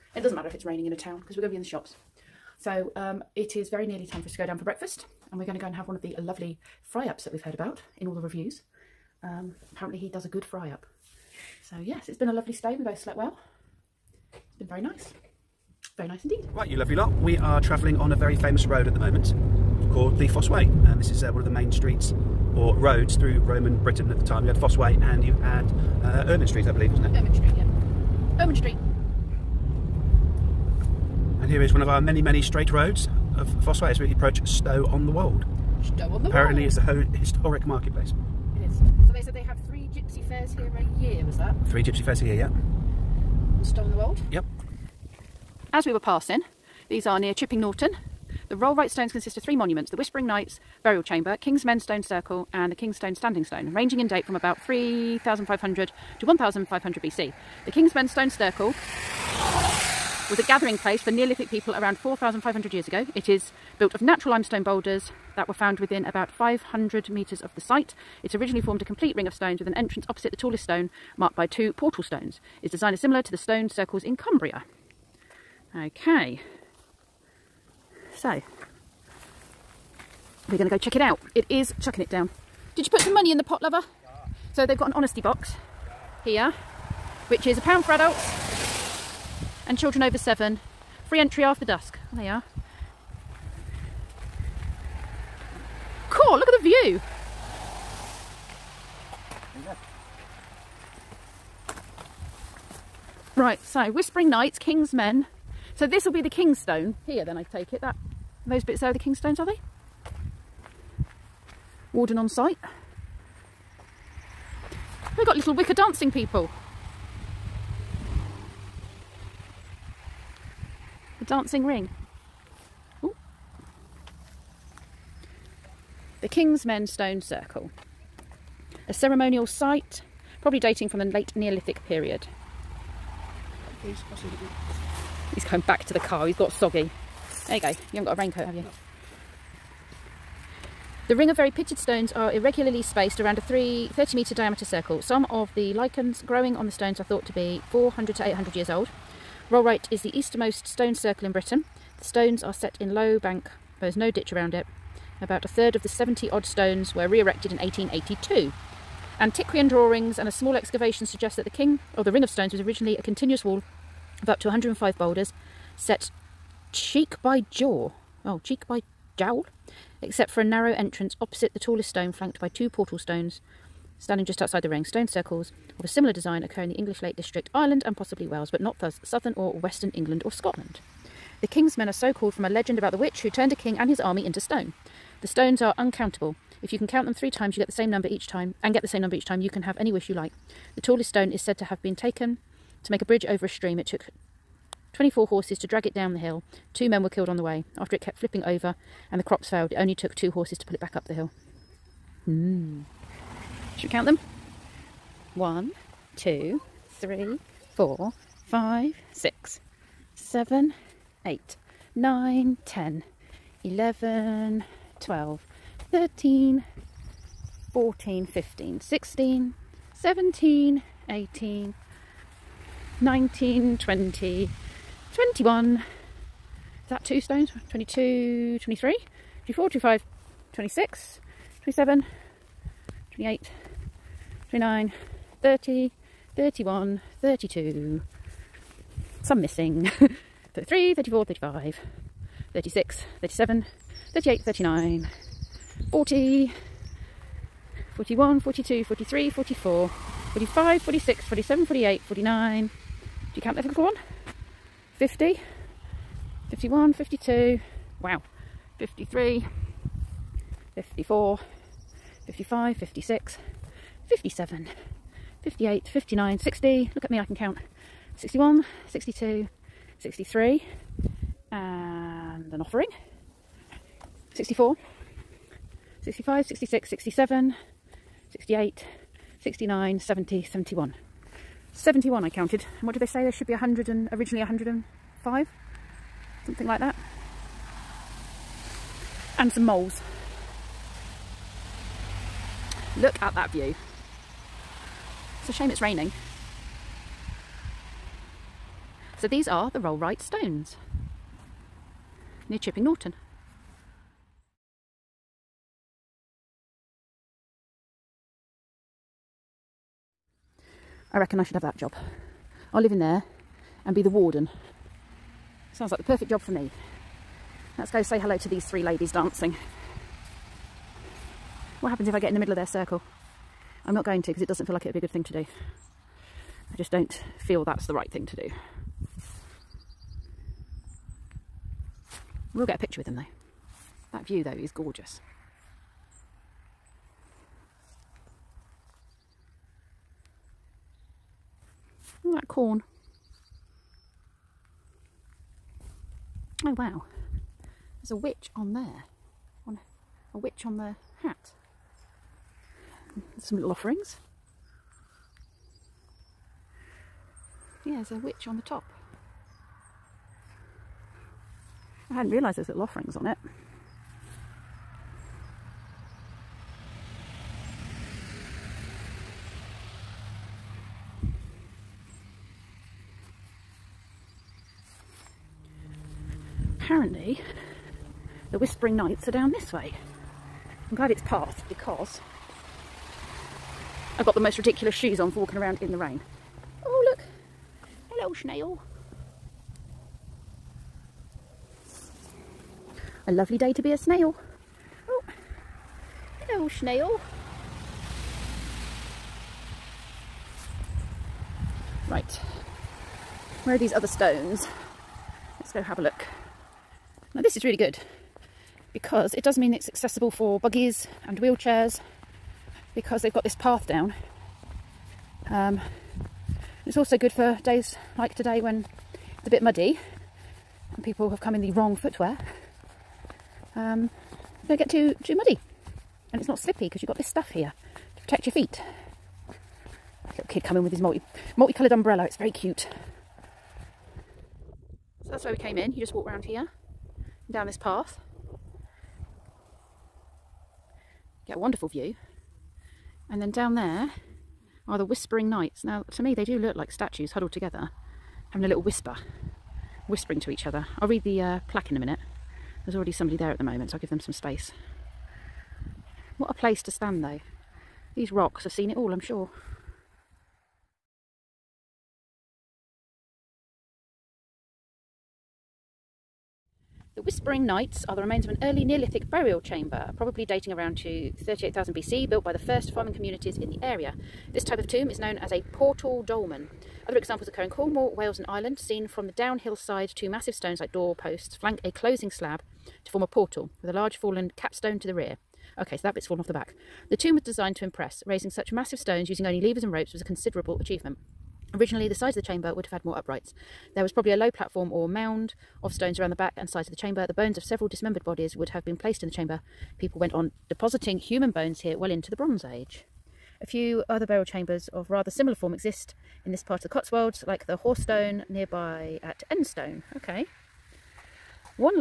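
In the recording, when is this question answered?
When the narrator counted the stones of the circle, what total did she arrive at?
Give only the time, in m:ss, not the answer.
4:41.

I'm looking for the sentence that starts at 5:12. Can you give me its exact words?
I'll live in there and be the warden.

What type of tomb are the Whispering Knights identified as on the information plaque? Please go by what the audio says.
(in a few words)
portal dolmen.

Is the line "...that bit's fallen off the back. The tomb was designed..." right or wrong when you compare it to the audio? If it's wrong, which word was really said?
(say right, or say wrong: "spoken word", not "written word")
right.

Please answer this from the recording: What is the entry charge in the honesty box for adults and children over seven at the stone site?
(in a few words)
a pound.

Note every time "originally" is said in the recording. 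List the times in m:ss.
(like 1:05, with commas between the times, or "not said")
1:08, 2:42, 4:44, 8:11.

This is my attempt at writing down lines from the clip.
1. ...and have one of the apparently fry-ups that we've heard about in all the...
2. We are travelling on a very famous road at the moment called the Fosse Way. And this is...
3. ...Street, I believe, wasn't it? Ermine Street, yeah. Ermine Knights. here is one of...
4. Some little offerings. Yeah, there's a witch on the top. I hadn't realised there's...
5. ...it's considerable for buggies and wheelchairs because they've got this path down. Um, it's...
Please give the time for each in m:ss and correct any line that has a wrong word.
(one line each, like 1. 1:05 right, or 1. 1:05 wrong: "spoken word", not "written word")
1. 0:05 wrong: "lovely", not "apparently"
2. 0:17 right
3. 0:26 wrong: "Street", not "Knights"
4. 5:53 right
5. 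6:49 wrong: "accessible", not "considerable".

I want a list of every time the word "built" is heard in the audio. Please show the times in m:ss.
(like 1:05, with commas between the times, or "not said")
1:03, 7:52.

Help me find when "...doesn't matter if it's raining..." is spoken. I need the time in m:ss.
0:00.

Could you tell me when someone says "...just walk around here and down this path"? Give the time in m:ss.
7:16.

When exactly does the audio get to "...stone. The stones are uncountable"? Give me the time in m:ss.
3:04.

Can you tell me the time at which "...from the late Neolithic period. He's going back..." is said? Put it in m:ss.
2:10.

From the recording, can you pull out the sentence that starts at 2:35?
About a third of the 70 odd stones were re erected in 1882.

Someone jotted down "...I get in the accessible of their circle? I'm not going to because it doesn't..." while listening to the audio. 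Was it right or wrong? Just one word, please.
wrong.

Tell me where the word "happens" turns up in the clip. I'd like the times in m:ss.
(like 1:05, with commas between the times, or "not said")
5:21.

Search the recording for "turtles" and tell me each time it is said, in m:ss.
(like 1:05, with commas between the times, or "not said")
not said.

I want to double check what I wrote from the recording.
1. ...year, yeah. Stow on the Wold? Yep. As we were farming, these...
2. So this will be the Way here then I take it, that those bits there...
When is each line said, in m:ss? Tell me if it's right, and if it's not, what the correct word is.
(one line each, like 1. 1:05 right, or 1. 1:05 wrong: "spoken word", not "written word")
1. 0:42 wrong: "passing", not "farming"
2. 1:45 wrong: "Kingstone", not "Way".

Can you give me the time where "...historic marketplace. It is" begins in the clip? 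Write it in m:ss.
0:37.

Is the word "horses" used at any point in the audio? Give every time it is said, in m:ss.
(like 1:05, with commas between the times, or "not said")
3:15, 3:20.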